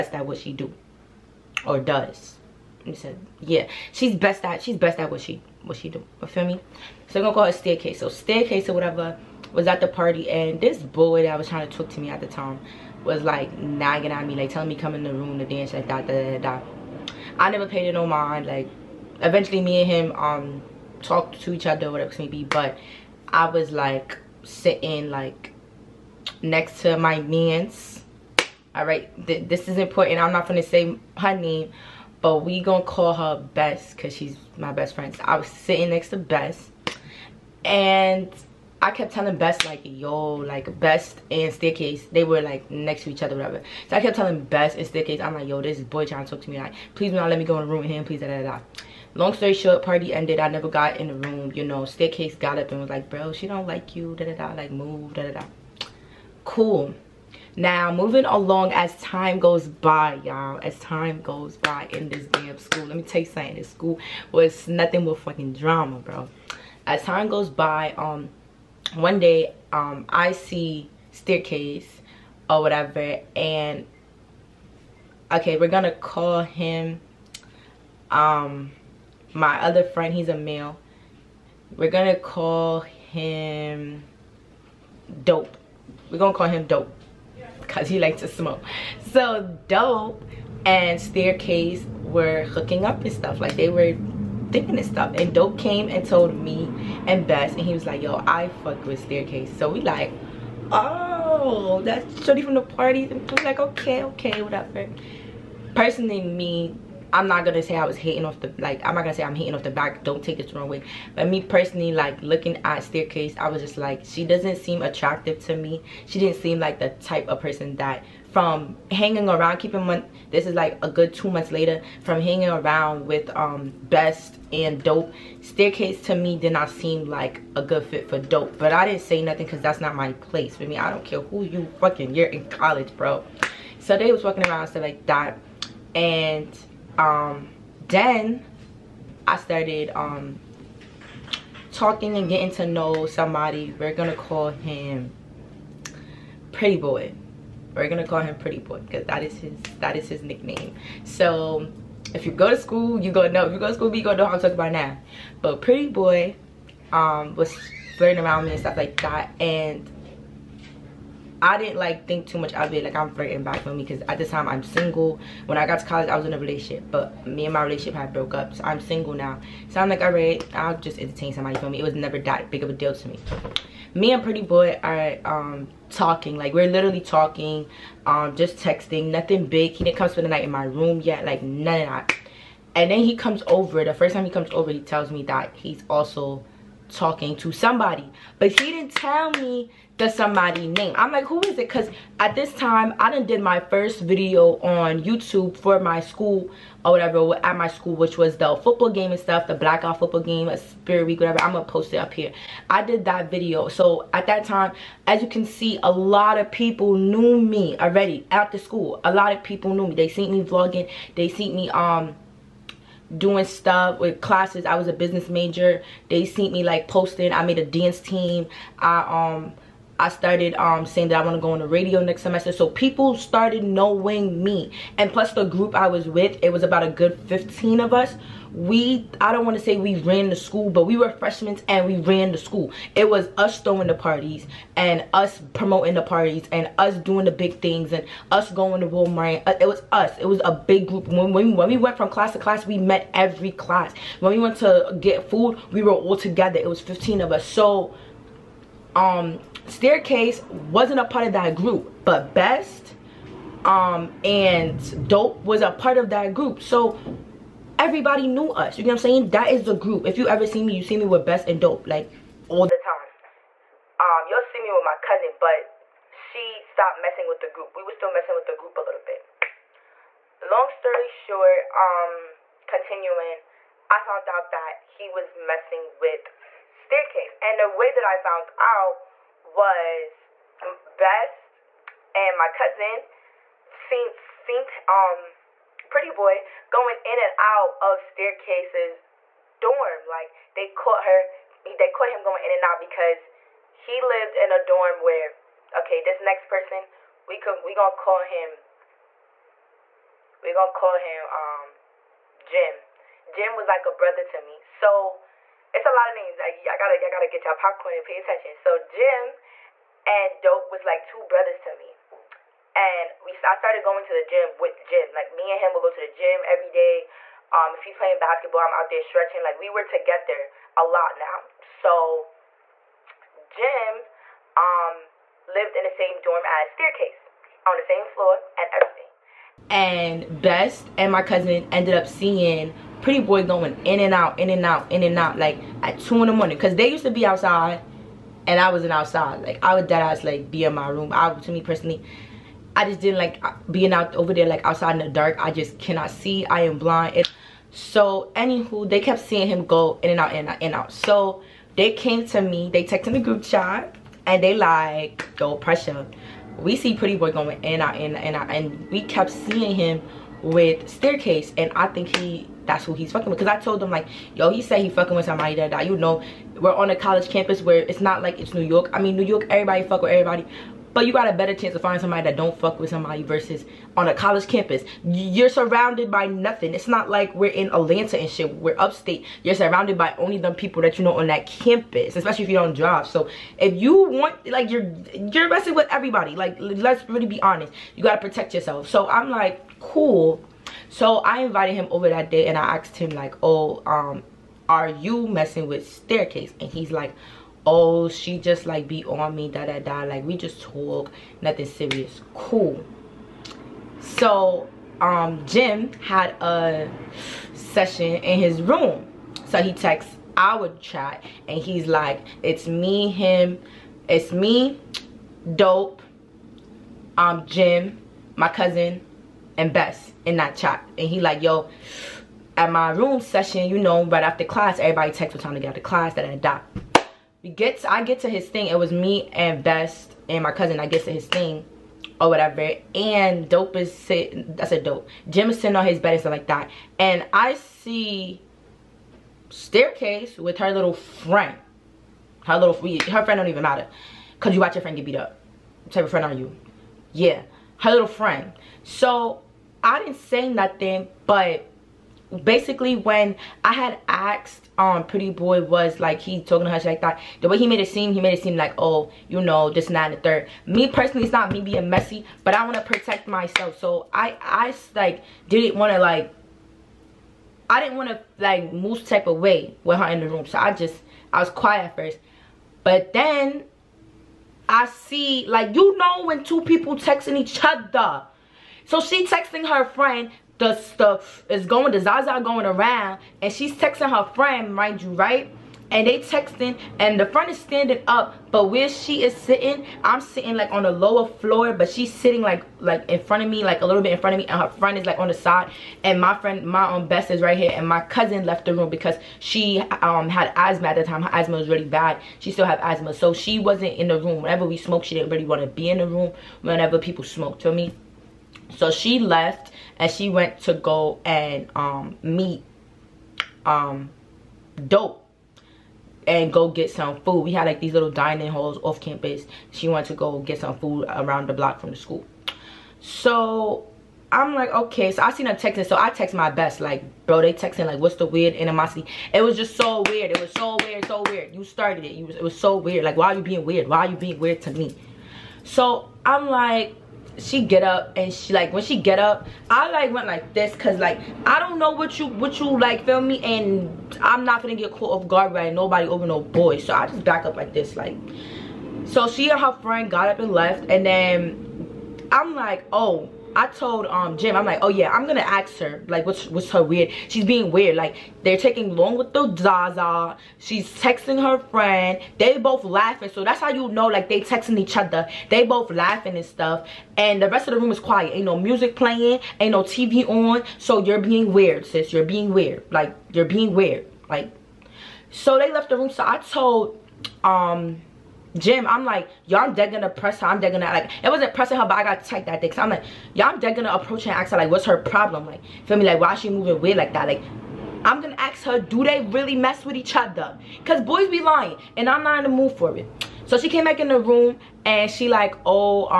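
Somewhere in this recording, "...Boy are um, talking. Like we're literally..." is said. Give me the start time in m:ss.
2:54.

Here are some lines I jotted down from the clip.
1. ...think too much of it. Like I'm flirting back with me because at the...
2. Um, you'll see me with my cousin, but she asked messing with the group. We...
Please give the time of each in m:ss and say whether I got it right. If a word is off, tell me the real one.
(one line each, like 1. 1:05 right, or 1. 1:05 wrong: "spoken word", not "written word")
1. 2:42 right
2. 4:23 wrong: "stopped", not "asked".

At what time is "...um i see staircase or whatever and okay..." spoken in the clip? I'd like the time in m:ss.
1:09.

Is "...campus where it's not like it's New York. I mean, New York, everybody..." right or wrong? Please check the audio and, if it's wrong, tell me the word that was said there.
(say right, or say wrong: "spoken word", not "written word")
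right.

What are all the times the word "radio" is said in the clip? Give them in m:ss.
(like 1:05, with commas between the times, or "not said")
3:41.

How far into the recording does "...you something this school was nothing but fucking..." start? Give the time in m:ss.
1:03.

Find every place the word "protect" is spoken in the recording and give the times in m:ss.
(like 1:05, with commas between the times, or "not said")
6:28, 7:42.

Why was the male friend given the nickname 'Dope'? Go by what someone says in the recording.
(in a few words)
He likes to smoke.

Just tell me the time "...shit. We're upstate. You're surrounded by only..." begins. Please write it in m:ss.
6:18.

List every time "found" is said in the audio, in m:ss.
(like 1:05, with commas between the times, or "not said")
4:34, 4:38.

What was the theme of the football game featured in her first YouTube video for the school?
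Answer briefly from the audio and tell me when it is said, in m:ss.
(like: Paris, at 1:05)
blackout, at 3:19.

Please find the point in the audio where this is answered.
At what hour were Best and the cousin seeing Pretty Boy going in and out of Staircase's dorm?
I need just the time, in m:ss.
5:35.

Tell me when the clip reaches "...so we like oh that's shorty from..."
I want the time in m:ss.
1:39.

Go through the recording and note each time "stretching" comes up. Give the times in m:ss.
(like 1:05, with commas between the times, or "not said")
5:19.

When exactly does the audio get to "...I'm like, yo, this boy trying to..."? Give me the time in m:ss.
0:45.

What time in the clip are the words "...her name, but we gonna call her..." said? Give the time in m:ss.
0:31.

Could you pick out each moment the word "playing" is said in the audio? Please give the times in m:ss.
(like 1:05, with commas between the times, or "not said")
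5:17, 9:28.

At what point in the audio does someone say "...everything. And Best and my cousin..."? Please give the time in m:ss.
5:28.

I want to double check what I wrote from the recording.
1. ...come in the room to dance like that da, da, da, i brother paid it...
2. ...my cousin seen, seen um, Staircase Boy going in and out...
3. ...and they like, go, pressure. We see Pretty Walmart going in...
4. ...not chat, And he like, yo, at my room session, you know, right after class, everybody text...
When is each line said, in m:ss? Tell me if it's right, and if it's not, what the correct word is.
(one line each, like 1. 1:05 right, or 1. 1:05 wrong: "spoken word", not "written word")
1. 0:14 wrong: "never", not "brother"
2. 4:42 wrong: "Pretty", not "Staircase"
3. 5:54 wrong: "Boy", not "Walmart"
4. 7:00 right.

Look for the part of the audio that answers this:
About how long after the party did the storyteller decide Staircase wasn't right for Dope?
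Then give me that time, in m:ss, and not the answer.
2:00.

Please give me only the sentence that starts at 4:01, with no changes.
When, when we went from class to class, we met every class.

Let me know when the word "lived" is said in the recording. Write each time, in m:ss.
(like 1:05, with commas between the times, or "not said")
4:53, 5:25.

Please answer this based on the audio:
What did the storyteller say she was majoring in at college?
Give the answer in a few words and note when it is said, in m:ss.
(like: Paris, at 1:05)
business, at 3:34.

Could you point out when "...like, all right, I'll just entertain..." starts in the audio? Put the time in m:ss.
2:49.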